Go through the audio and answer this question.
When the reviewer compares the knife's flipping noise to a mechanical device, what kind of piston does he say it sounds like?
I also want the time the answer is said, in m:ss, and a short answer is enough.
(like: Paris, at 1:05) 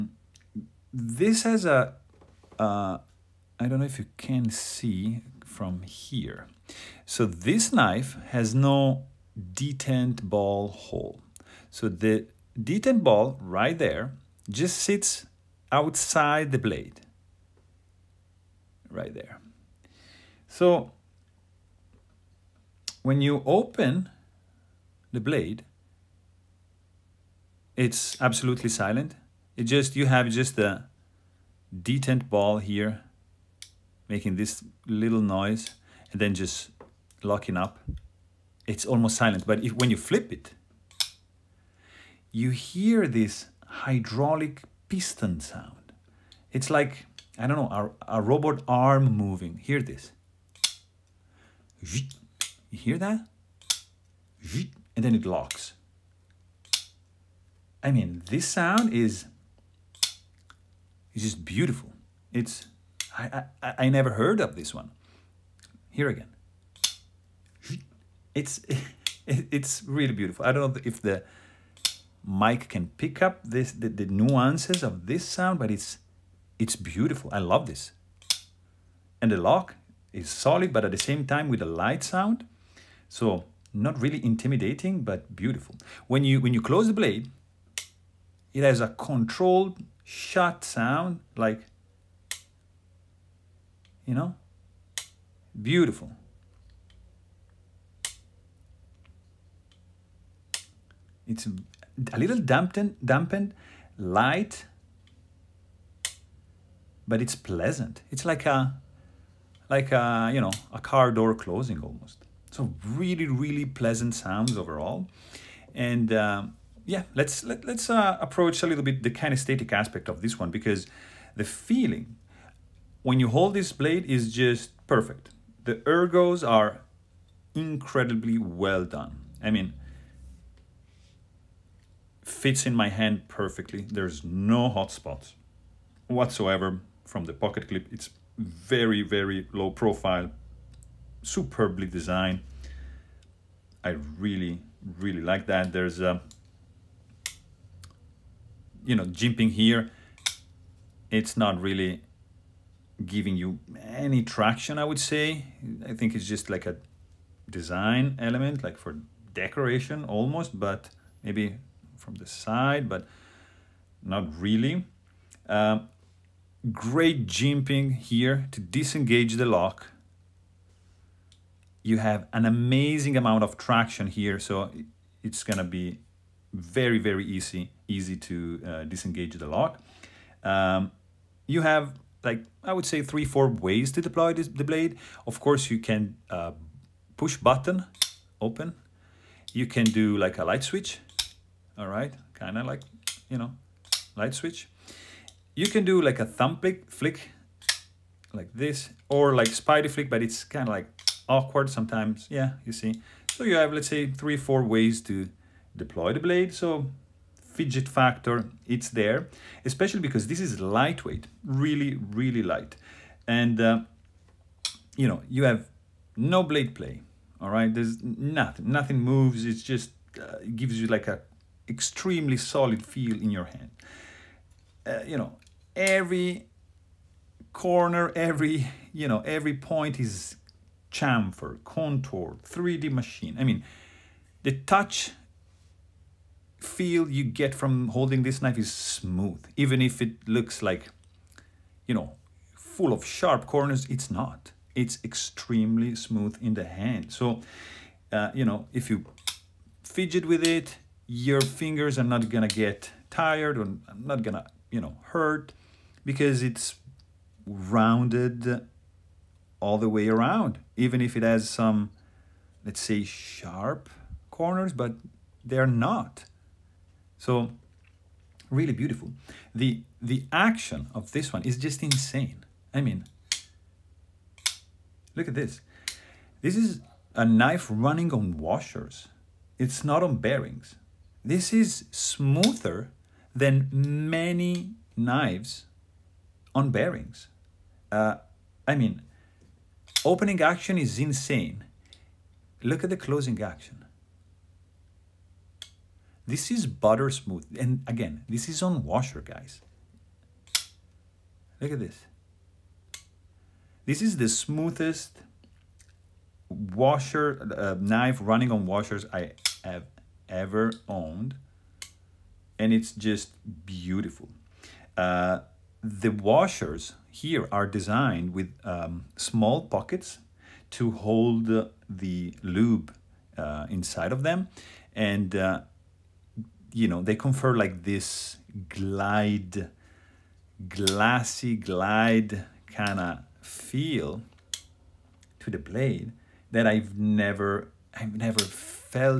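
hydraulic, at 0:43.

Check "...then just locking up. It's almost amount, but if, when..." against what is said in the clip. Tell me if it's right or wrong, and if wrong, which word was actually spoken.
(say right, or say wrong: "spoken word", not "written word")
wrong: "silent", not "amount".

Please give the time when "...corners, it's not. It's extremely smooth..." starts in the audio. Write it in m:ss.
4:03.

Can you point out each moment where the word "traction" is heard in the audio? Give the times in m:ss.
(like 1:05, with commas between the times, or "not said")
2:34, 2:53.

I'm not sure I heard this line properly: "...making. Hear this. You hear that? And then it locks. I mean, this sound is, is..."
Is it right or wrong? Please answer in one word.
wrong.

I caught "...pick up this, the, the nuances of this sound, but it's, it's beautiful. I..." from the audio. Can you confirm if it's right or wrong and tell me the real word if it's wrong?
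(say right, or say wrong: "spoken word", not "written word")
right.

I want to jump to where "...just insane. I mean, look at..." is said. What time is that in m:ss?
4:31.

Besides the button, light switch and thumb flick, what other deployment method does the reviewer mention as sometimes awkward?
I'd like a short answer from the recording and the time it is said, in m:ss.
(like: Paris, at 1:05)
spidey flick, at 3:19.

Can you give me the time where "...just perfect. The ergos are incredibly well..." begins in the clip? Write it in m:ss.
2:04.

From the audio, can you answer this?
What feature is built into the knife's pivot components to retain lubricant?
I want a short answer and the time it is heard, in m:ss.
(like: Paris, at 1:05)
small pockets, at 5:19.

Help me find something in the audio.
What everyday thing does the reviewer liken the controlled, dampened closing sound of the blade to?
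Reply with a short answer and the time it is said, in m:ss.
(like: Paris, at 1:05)
a car door closing, at 1:50.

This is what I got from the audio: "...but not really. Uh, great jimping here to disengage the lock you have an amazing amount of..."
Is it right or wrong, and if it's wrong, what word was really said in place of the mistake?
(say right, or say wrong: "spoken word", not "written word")
right.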